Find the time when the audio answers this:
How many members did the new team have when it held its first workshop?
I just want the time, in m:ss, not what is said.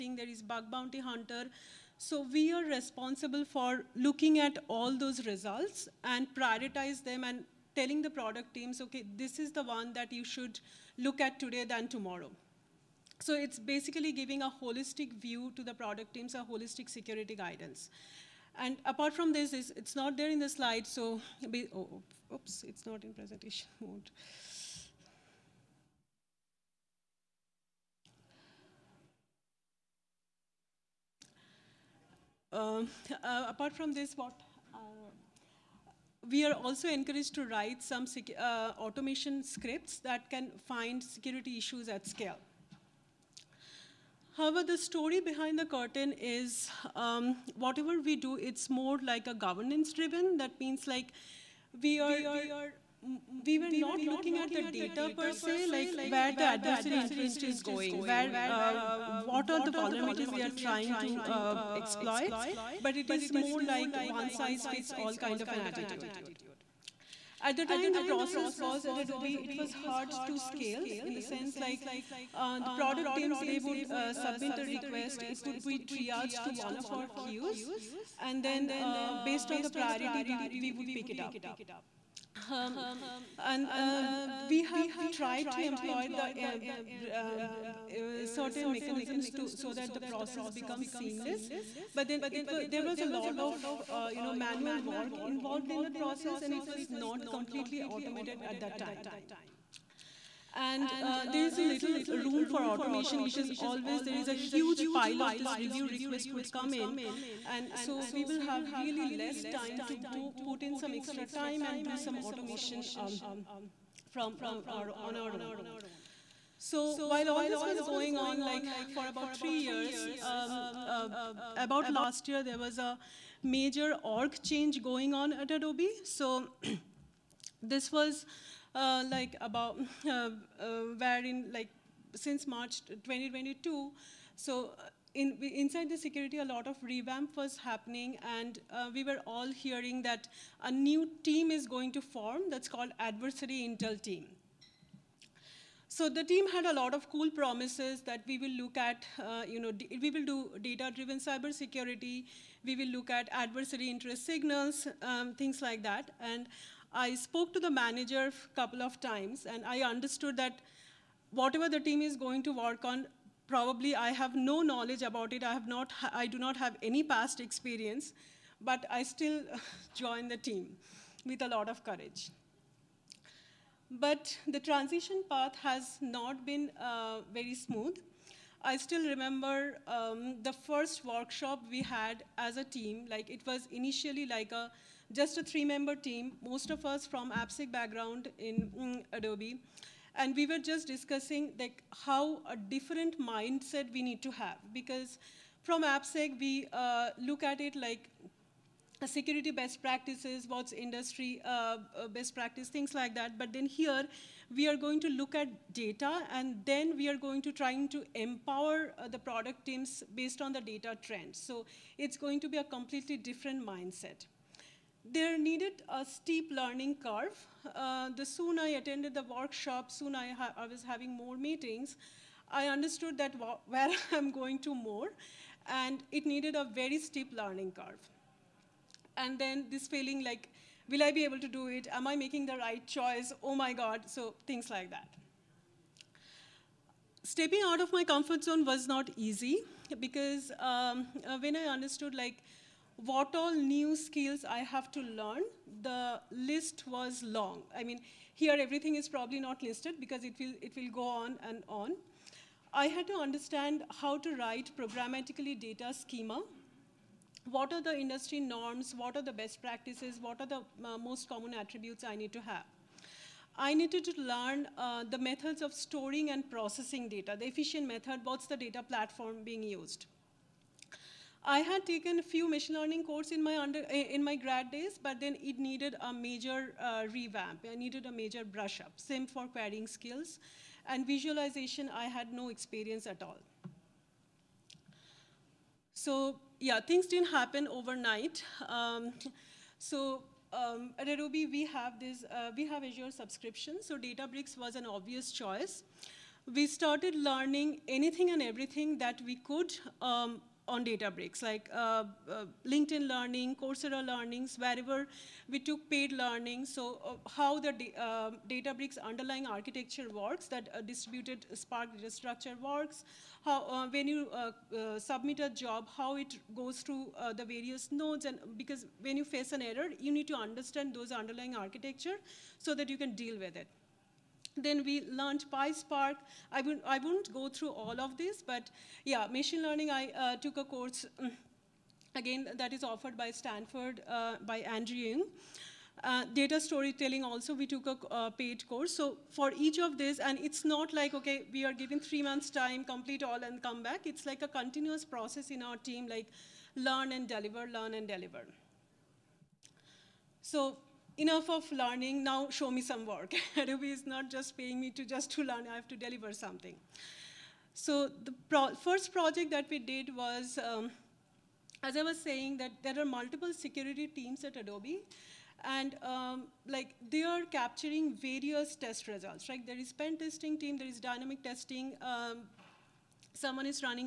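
3:05.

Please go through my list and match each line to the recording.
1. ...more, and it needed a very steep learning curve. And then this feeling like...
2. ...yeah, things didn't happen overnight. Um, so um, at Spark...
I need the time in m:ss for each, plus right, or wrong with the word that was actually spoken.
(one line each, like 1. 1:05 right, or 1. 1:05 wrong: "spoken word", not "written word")
1. 3:44 right
2. 4:46 wrong: "Adobe", not "Spark".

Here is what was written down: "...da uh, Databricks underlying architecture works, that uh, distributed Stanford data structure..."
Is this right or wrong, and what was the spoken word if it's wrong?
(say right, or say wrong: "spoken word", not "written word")
wrong: "Spark", not "Stanford".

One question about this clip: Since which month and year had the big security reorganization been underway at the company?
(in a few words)
March 2022.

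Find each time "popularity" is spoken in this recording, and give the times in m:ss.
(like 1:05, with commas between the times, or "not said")
not said.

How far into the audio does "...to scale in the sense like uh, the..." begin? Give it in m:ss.
1:10.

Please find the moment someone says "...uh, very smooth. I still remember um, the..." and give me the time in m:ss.
2:56.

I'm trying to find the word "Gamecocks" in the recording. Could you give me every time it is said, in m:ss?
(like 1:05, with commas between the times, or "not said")
not said.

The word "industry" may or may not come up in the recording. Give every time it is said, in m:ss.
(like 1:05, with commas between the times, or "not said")
3:20, 4:17.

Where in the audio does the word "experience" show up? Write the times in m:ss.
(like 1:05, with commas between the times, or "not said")
2:47, 4:42.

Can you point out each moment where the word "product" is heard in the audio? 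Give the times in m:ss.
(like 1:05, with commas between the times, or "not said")
0:08, 0:15, 1:12, 3:29.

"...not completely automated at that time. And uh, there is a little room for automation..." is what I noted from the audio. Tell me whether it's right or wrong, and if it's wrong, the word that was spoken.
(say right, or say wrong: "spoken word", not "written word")
right.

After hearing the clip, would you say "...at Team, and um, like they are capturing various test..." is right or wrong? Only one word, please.
wrong.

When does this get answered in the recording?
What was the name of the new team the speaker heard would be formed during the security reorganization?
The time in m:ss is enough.
2:22.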